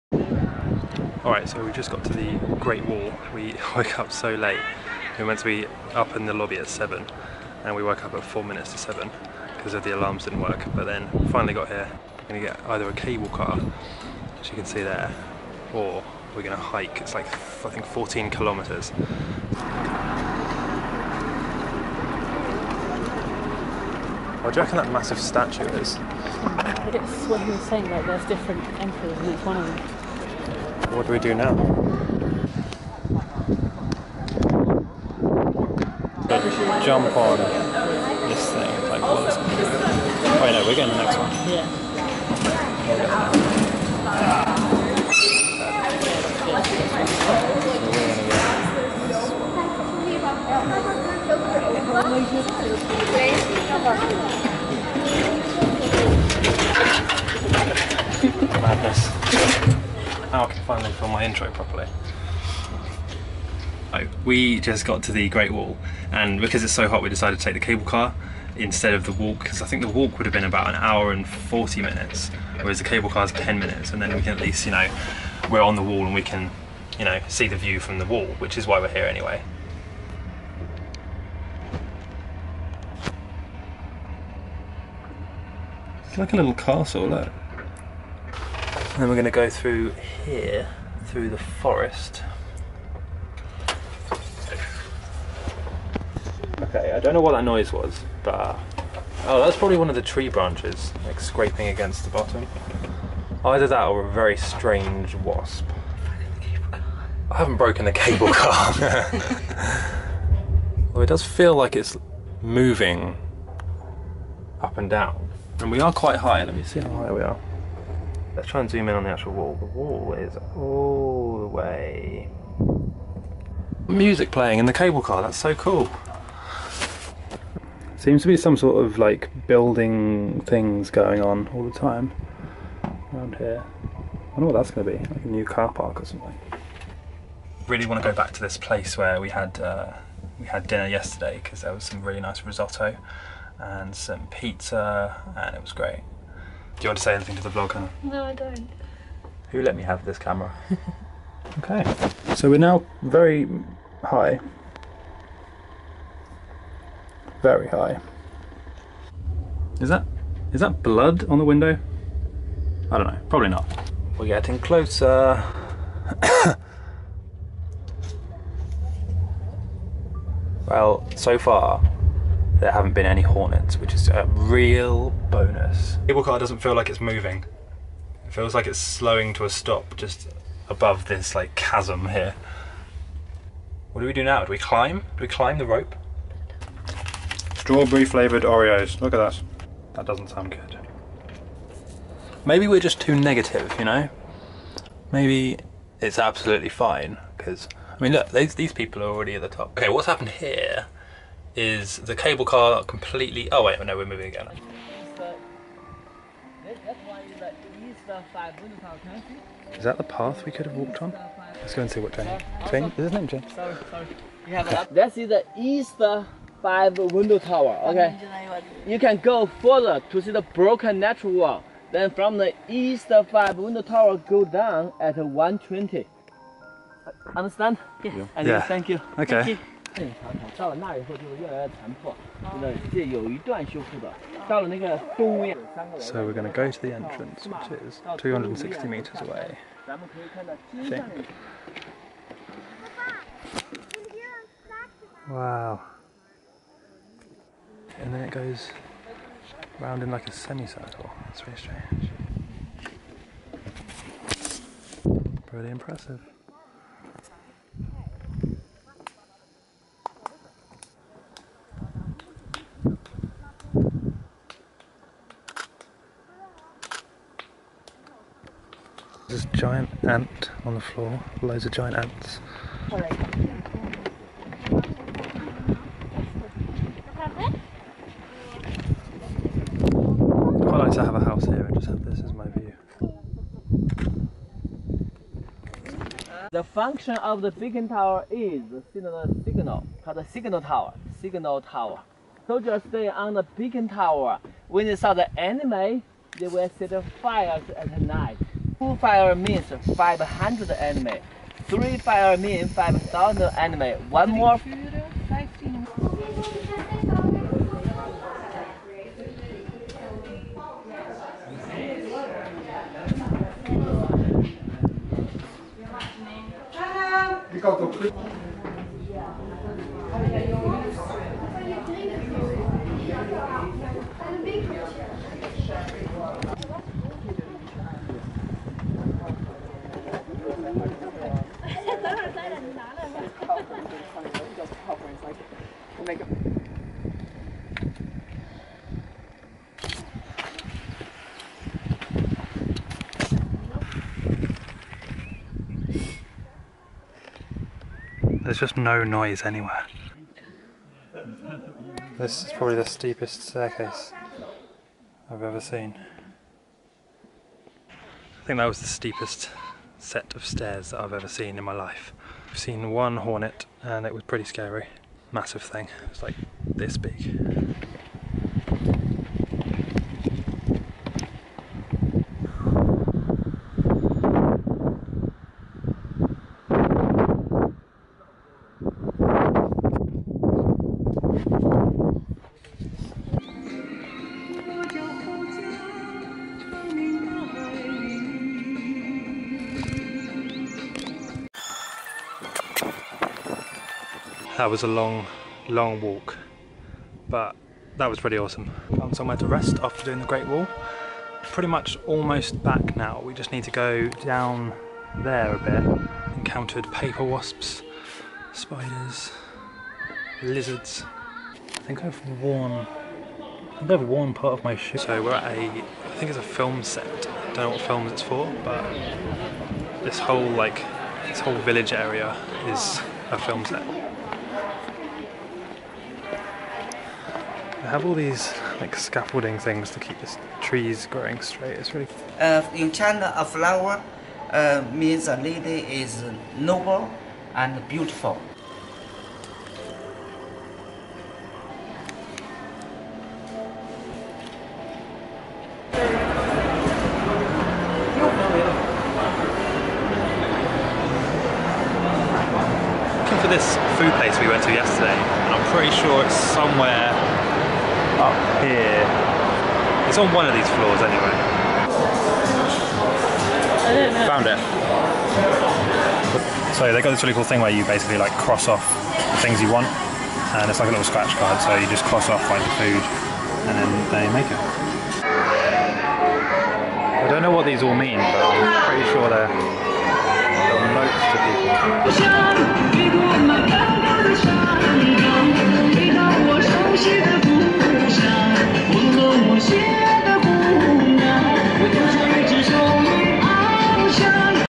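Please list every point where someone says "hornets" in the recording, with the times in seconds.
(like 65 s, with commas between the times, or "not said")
173 s, 363 s.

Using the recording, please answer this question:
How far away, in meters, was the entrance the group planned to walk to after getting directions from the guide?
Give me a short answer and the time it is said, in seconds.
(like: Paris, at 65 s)
260 meters, at 238 s.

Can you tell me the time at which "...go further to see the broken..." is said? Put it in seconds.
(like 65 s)
219 s.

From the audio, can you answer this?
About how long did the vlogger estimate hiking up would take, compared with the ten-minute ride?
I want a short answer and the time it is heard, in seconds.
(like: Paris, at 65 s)
1 hour 40 minutes, at 70 s.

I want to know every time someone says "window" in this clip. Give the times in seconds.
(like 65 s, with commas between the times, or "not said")
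161 s, 216 s, 223 s.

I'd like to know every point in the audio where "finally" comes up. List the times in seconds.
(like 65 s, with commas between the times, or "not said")
11 s, 60 s.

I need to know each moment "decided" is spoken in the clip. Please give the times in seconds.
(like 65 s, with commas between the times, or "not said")
67 s.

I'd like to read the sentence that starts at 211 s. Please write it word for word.
Let's go and see what Jane...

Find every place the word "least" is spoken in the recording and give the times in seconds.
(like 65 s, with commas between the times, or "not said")
74 s.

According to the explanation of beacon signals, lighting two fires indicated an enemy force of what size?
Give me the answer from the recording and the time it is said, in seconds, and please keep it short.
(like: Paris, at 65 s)
500, at 299 s.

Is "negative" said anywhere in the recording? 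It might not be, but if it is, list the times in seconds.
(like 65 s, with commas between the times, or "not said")
193 s.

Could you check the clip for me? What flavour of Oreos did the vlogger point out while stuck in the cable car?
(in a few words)
strawberry.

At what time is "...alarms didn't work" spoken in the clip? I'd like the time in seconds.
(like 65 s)
9 s.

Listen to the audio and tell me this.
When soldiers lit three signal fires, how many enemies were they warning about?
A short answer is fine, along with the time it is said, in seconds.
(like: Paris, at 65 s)
5,000, at 302 s.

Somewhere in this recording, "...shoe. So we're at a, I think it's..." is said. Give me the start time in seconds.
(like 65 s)
414 s.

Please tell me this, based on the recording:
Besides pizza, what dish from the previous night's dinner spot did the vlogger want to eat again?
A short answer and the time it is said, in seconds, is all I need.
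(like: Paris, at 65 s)
risotto, at 142 s.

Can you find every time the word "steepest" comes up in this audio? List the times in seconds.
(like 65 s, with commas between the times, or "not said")
352 s, 358 s.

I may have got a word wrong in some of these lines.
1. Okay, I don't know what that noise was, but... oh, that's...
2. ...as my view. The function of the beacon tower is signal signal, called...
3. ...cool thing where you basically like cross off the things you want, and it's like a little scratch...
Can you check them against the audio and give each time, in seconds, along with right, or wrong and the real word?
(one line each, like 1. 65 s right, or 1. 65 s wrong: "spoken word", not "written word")
1. 96 s right
2. 282 s right
3. 467 s right.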